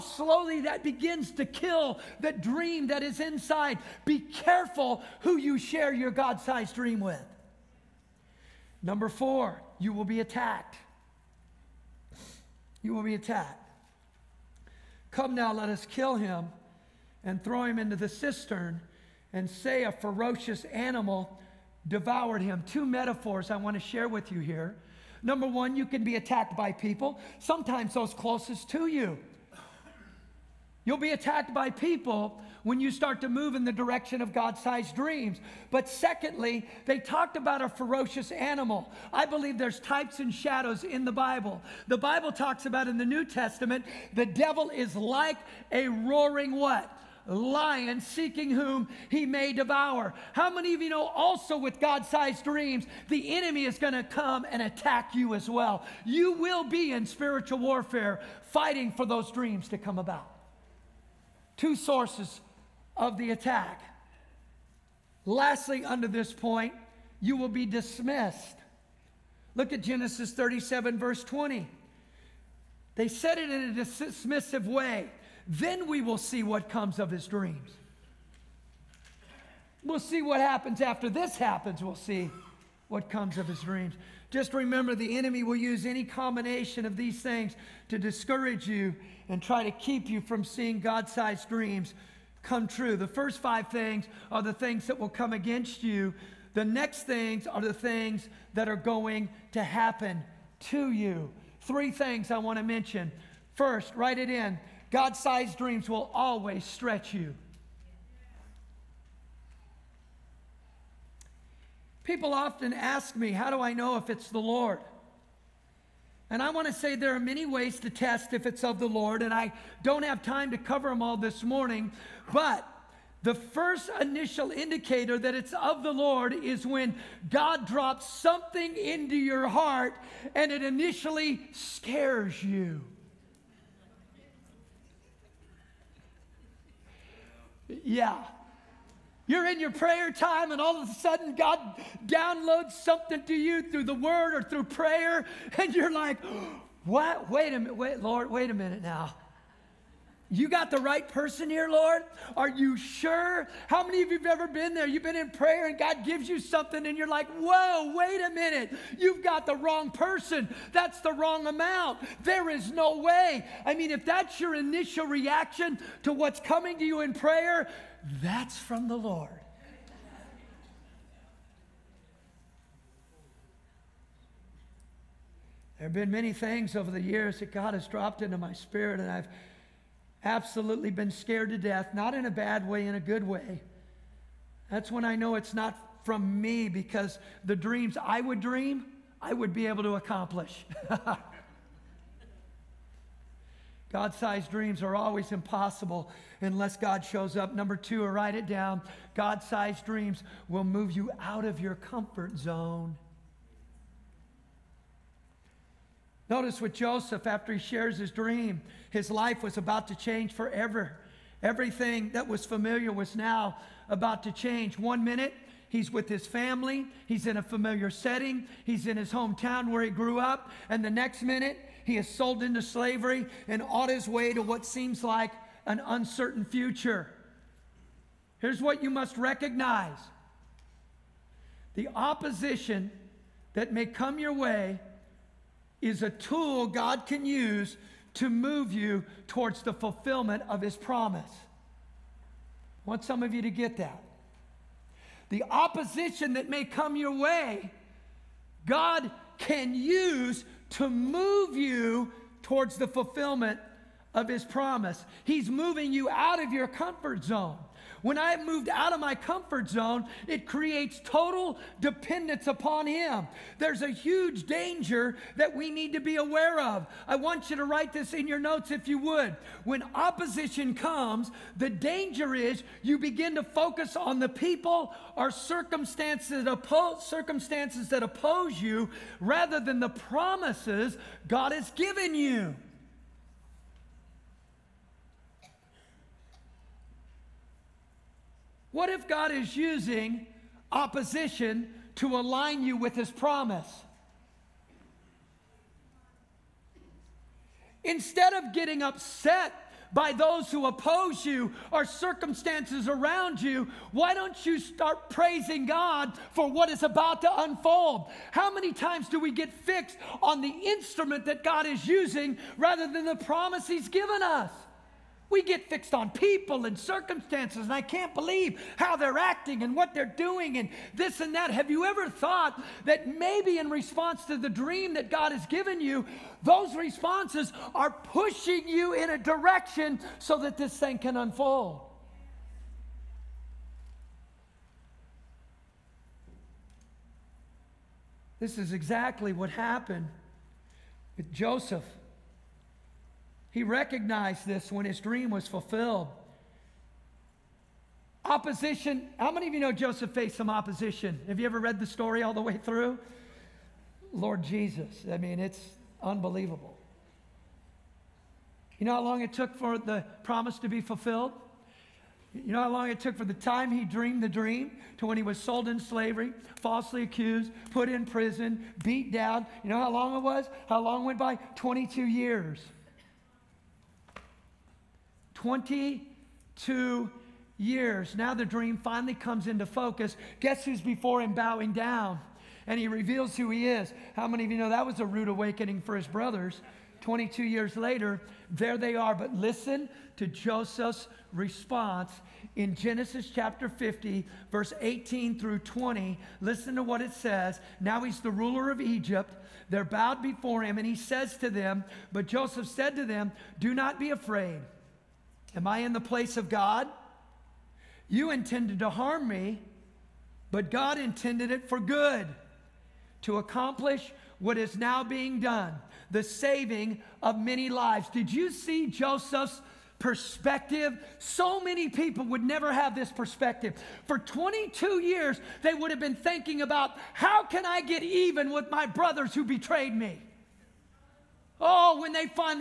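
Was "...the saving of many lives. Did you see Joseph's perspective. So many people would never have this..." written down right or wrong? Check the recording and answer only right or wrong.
right.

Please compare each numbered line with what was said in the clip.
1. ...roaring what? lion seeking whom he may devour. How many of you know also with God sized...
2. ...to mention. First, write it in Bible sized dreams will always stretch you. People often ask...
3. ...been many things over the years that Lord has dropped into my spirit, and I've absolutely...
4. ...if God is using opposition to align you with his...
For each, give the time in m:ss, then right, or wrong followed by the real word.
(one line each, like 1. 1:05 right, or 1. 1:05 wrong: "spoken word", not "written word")
1. 0:45 right
2. 1:42 wrong: "God", not "Bible"
3. 2:55 wrong: "God", not "Lord"
4. 4:48 right.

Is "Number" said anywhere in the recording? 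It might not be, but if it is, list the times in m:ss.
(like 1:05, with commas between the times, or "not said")
0:08, 0:25, 3:17.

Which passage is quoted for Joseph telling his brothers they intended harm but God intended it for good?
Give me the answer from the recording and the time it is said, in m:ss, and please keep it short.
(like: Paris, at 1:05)
Genesis 50:18-20, at 6:32.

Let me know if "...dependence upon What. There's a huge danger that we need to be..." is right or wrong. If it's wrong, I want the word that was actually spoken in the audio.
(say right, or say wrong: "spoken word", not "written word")
wrong: "Him", not "What".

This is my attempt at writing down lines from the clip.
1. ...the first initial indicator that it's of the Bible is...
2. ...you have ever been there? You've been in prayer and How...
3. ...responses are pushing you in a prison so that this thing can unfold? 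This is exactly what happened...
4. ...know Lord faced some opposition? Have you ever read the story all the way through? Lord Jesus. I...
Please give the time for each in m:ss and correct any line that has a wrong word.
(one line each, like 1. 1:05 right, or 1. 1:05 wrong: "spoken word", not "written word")
1. 2:03 wrong: "Lord", not "Bible"
2. 2:34 wrong: "God", not "How"
3. 5:26 wrong: "direction", not "prison"
4. 5:49 wrong: "Joseph", not "Lord".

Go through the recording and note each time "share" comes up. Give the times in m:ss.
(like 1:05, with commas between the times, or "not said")
0:05, 0:23, 3:27.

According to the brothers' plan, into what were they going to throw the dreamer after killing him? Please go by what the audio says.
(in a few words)
The cistern.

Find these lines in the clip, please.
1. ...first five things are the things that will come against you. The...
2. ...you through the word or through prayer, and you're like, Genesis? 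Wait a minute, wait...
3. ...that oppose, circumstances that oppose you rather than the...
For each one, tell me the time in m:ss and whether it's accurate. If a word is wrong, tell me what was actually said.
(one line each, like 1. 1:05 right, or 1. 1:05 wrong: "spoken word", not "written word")
1. 1:33 right
2. 2:23 wrong: "What", not "Genesis"
3. 4:36 right.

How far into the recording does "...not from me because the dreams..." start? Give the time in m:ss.
3:05.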